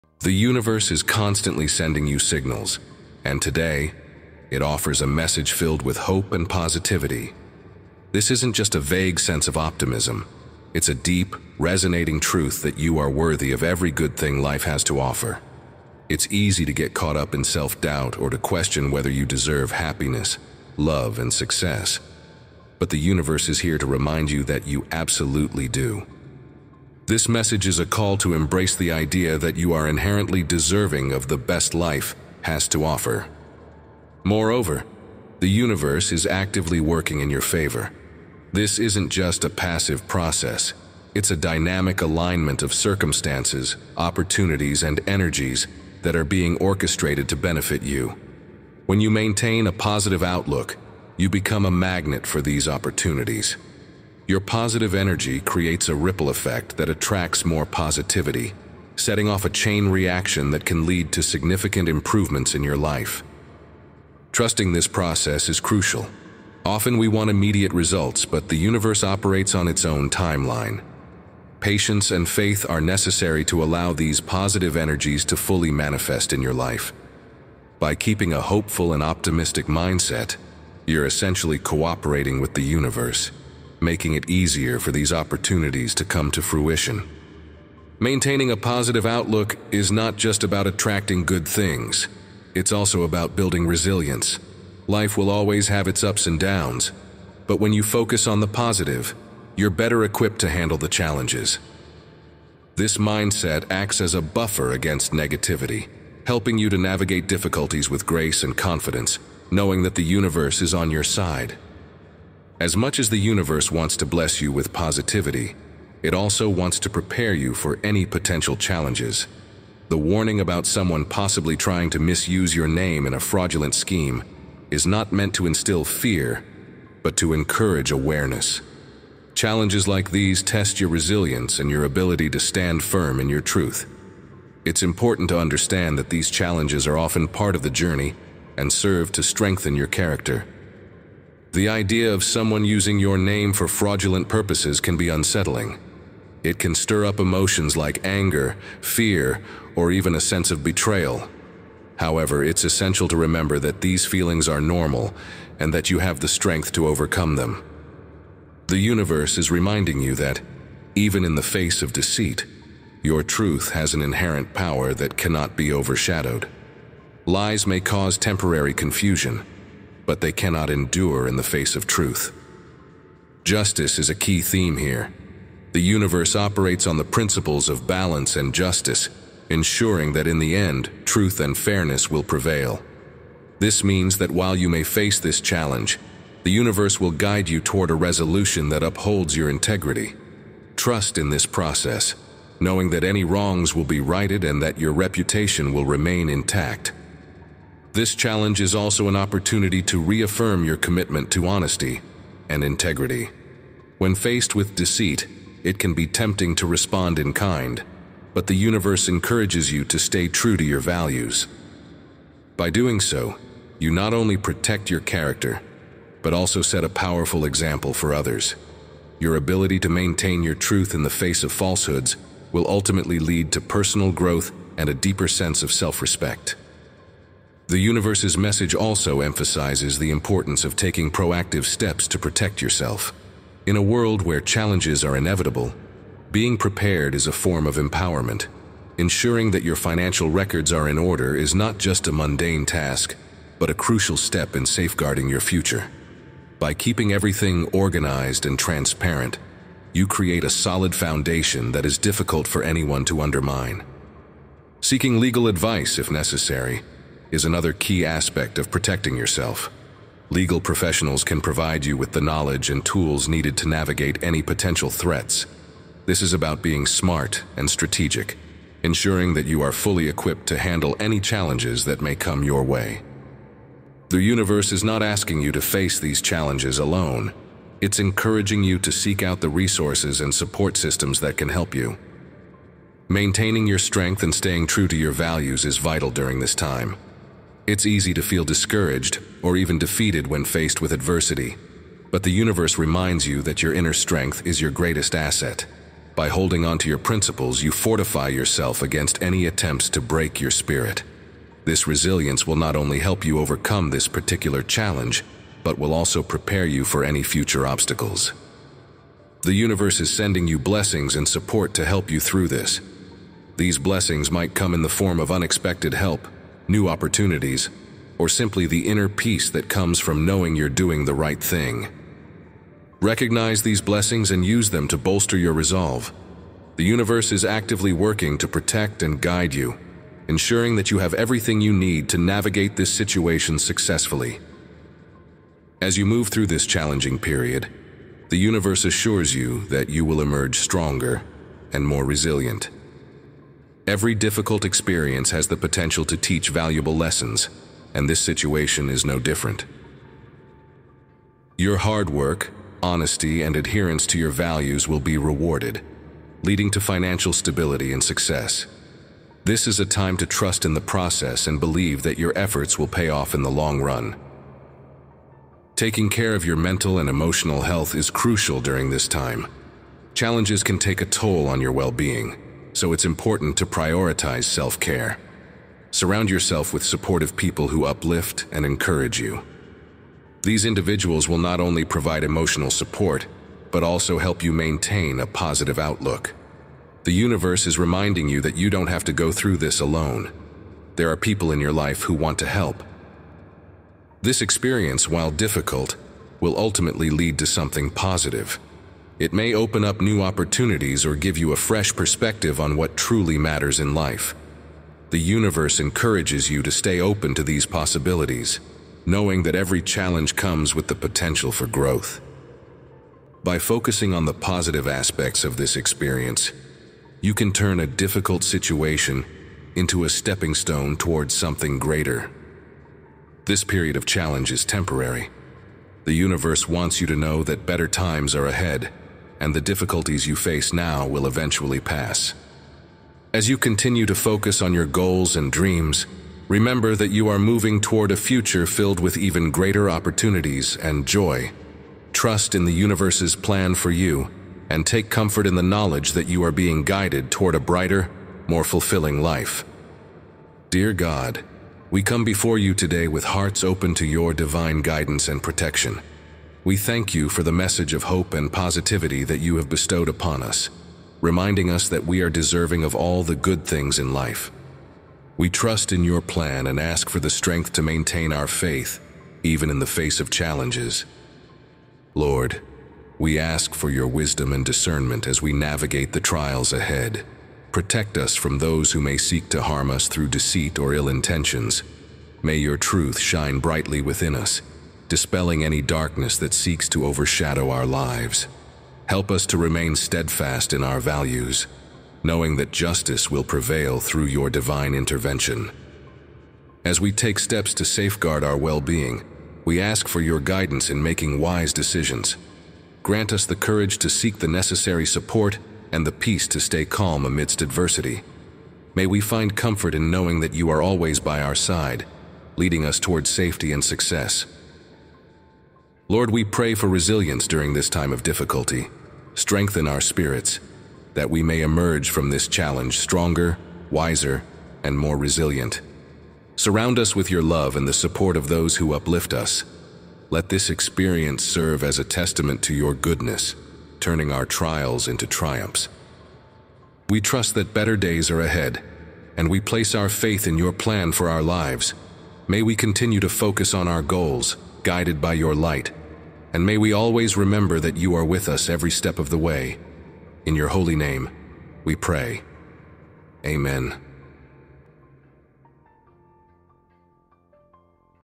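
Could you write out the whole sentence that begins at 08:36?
Lord, we pray for resilience during this time of difficulty.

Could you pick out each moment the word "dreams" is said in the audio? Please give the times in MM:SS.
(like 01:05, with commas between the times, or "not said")
07:15.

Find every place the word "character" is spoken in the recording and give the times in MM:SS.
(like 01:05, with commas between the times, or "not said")
02:19, 03:35.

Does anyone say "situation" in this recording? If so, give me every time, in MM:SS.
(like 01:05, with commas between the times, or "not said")
05:32, 05:48, 06:58.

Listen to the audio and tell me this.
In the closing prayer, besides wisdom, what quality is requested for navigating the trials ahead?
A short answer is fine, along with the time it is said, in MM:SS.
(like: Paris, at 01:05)
Discernment, at 07:54.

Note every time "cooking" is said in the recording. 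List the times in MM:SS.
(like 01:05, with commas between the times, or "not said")
not said.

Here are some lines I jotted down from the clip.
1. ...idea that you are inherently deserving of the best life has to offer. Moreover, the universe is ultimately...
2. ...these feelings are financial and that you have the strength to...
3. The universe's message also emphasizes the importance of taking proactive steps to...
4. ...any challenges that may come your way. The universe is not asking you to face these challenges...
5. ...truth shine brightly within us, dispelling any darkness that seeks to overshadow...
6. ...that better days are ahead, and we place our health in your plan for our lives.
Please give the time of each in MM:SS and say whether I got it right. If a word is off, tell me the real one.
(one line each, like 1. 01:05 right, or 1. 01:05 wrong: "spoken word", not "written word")
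1. 00:28 wrong: "actively", not "ultimately"
2. 02:33 wrong: "normal", not "financial"
3. 03:47 right
4. 04:30 right
5. 08:02 right
6. 08:57 wrong: "faith", not "health".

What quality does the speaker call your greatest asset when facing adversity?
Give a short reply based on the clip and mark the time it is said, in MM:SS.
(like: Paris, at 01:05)
Inner strength, at 04:53.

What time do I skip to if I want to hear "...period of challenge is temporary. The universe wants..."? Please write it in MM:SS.
07:03.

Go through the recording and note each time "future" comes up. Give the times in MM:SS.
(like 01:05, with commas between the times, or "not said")
04:05, 05:07, 07:18.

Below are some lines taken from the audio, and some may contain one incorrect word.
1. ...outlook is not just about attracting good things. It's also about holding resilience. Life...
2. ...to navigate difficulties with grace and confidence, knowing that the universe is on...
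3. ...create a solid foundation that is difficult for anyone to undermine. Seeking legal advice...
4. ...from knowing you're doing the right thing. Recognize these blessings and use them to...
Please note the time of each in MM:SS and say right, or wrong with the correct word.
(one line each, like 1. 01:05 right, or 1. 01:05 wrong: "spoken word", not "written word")
1. 01:29 wrong: "building", not "holding"
2. 01:46 right
3. 04:10 right
4. 05:19 right.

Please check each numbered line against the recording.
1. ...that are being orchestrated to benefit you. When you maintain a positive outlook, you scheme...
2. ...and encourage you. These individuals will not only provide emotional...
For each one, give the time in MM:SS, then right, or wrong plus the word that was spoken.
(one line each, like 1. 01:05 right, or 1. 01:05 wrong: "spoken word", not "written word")
1. 00:46 wrong: "become", not "scheme"
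2. 06:18 right.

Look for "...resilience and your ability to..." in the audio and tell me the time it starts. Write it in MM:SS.
02:10.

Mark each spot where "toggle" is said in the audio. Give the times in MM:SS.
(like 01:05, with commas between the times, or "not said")
not said.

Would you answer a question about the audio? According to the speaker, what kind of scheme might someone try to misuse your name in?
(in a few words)
A fraudulent scheme.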